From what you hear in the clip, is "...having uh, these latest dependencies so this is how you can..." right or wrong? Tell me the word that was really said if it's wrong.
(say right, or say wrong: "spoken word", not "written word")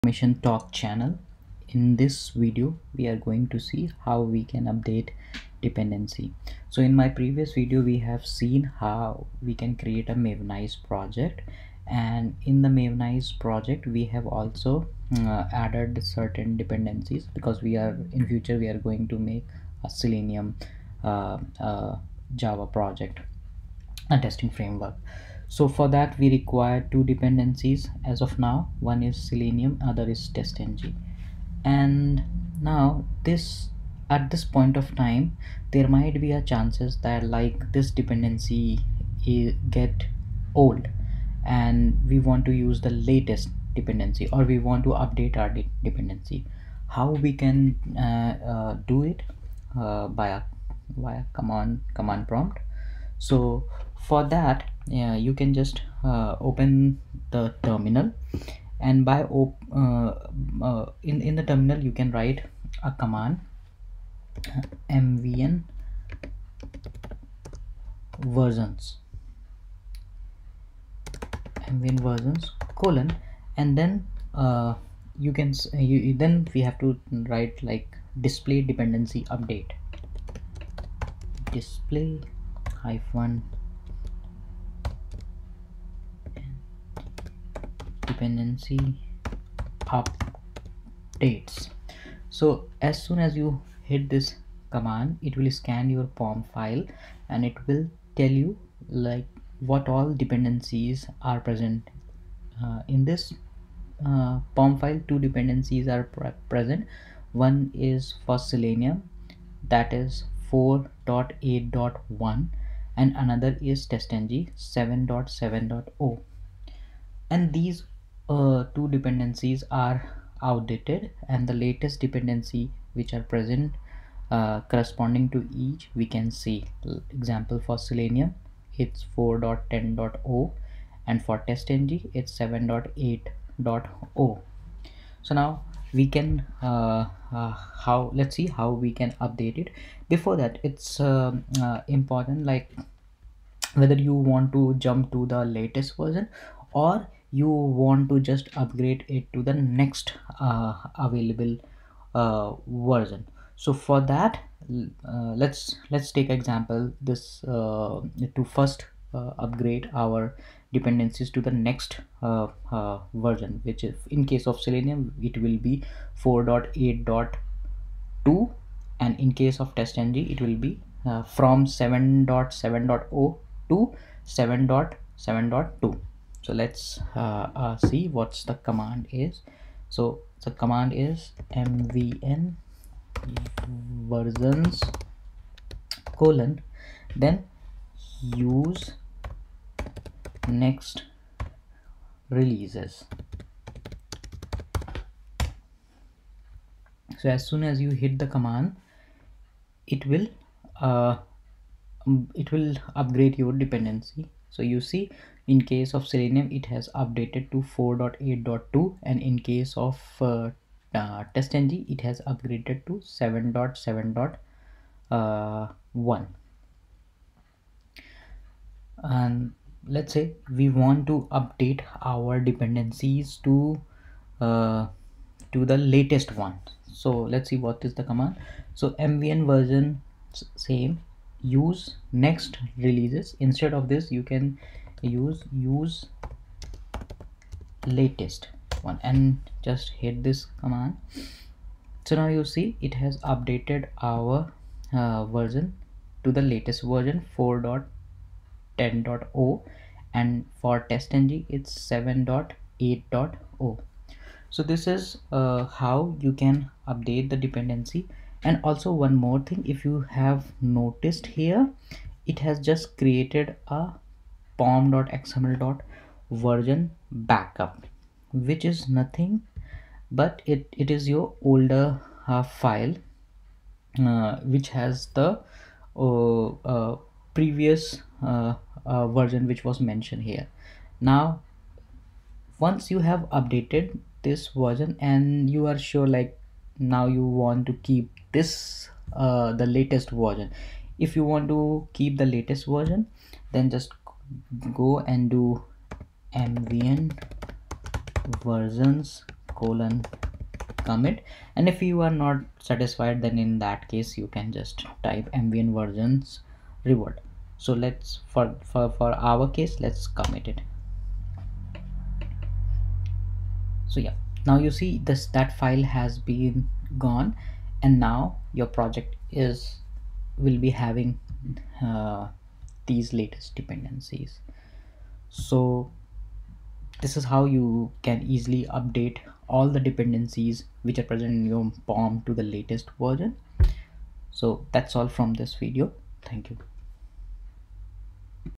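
right.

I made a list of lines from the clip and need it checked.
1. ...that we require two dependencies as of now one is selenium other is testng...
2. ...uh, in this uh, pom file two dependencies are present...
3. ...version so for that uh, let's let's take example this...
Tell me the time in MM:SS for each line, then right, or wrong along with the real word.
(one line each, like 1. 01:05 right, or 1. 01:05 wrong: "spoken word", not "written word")
1. 00:25 right
2. 01:42 right
3. 02:32 right.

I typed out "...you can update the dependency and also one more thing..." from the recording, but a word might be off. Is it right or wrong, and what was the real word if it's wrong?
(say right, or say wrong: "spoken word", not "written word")
right.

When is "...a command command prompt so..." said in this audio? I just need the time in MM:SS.
00:51.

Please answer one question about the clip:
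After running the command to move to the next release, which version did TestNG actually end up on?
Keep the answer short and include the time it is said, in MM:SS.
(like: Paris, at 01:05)
7.7.1, at 03:33.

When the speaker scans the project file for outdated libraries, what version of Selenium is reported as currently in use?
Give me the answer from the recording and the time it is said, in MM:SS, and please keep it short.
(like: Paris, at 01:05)
4.8.1, at 01:50.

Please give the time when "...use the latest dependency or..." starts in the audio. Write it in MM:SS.
00:42.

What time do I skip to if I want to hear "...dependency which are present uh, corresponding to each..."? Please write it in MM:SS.
02:02.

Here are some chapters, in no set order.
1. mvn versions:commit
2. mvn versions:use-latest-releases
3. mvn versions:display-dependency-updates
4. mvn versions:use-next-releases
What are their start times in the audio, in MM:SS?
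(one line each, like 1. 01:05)
1. 04:48
2. 03:43
3. 01:00
4. 02:38.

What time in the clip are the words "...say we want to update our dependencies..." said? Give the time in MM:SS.
03:40.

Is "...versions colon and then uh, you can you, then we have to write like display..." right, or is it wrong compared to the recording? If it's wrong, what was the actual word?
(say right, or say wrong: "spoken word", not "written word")
right.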